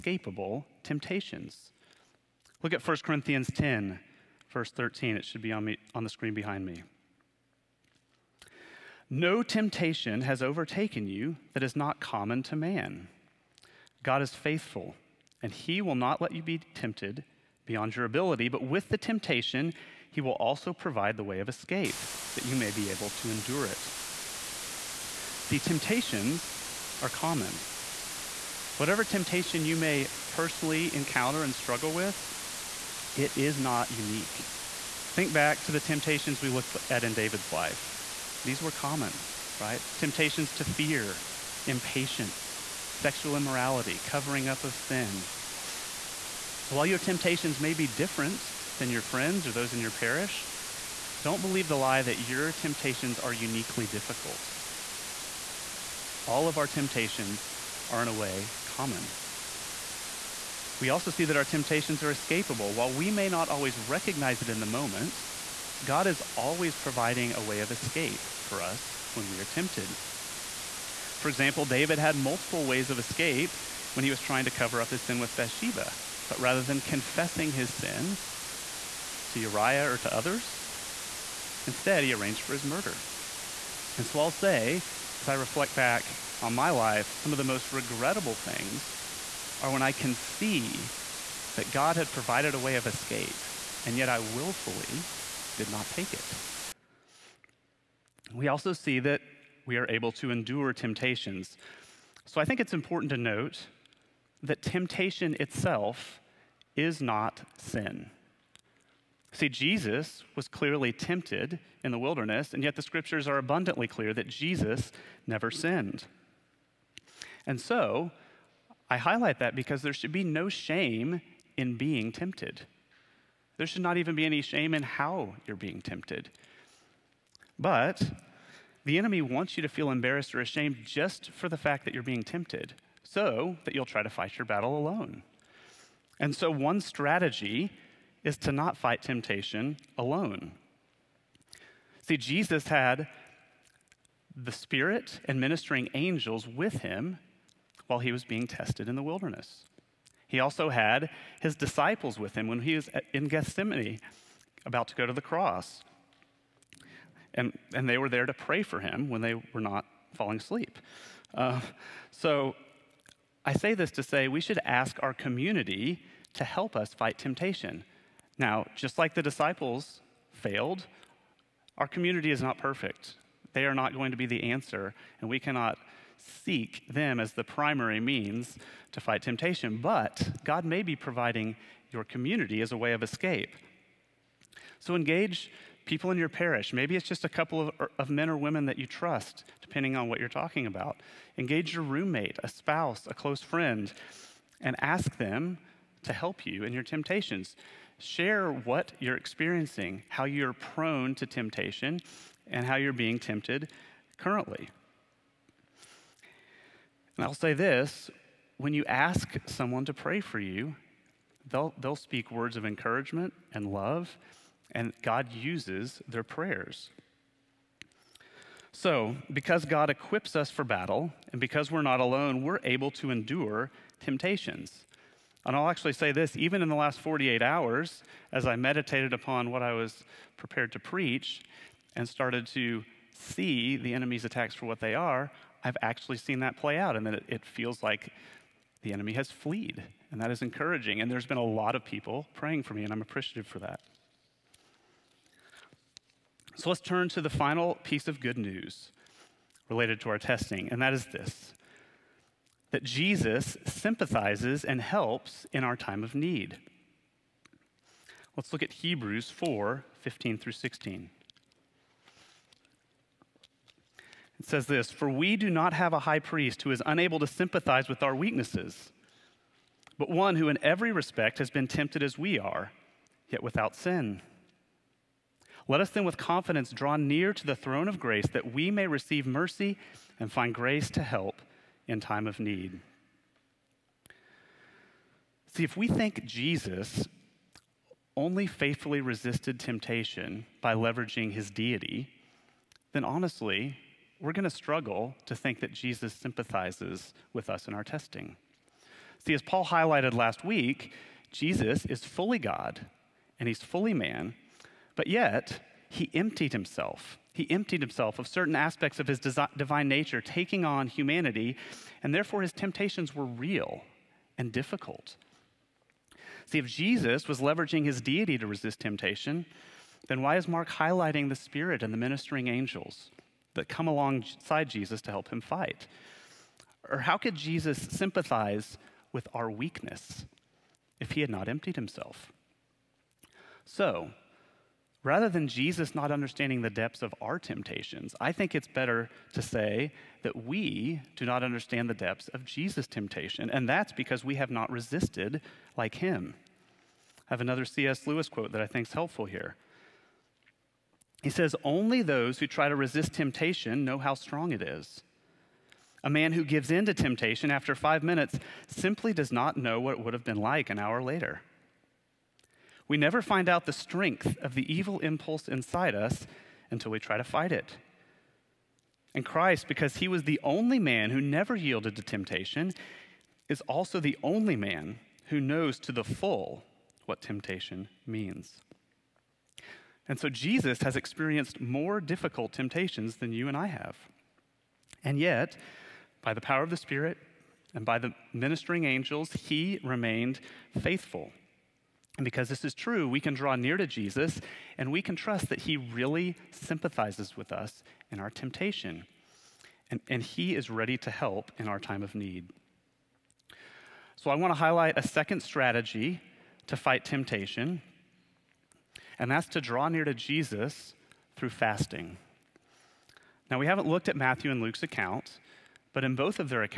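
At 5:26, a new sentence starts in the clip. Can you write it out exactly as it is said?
Or how could Jesus sympathize with our weakness if he had not emptied himself?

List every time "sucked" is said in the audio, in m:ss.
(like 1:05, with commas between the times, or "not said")
not said.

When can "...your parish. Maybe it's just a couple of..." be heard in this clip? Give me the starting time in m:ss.
3:06.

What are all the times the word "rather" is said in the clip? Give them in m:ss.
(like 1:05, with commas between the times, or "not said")
1:16, 5:35.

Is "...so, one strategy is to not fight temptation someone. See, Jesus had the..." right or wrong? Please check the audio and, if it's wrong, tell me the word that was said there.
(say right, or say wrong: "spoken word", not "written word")
wrong: "alone", not "someone".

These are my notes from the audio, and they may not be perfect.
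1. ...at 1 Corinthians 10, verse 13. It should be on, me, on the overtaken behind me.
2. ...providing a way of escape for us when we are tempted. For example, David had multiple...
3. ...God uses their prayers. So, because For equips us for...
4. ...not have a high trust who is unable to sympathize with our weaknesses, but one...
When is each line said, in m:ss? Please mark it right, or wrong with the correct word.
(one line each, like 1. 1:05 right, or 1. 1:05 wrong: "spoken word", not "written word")
1. 0:02 wrong: "screen", not "overtaken"
2. 1:06 right
3. 3:35 wrong: "God", not "For"
4. 4:25 wrong: "priest", not "trust".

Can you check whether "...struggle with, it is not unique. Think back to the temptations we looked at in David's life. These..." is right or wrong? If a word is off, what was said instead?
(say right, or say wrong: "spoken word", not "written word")
right.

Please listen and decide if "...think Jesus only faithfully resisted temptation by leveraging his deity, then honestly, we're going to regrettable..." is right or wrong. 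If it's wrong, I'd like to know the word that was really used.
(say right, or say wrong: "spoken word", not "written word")
wrong: "struggle", not "regrettable".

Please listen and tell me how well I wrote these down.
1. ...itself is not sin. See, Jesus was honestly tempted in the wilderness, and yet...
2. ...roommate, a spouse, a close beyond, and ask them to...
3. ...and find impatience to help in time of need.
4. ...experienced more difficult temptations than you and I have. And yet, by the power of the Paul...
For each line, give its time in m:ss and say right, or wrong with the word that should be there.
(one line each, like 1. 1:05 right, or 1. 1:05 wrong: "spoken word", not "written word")
1. 1:45 wrong: "clearly", not "honestly"
2. 3:11 wrong: "friend", not "beyond"
3. 4:40 wrong: "grace", not "impatience"
4. 6:20 wrong: "Spirit", not "Paul".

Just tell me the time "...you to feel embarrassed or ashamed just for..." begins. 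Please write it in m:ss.
2:09.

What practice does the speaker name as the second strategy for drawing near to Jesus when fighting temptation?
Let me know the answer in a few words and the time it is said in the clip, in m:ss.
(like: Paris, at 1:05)
fasting, at 6:51.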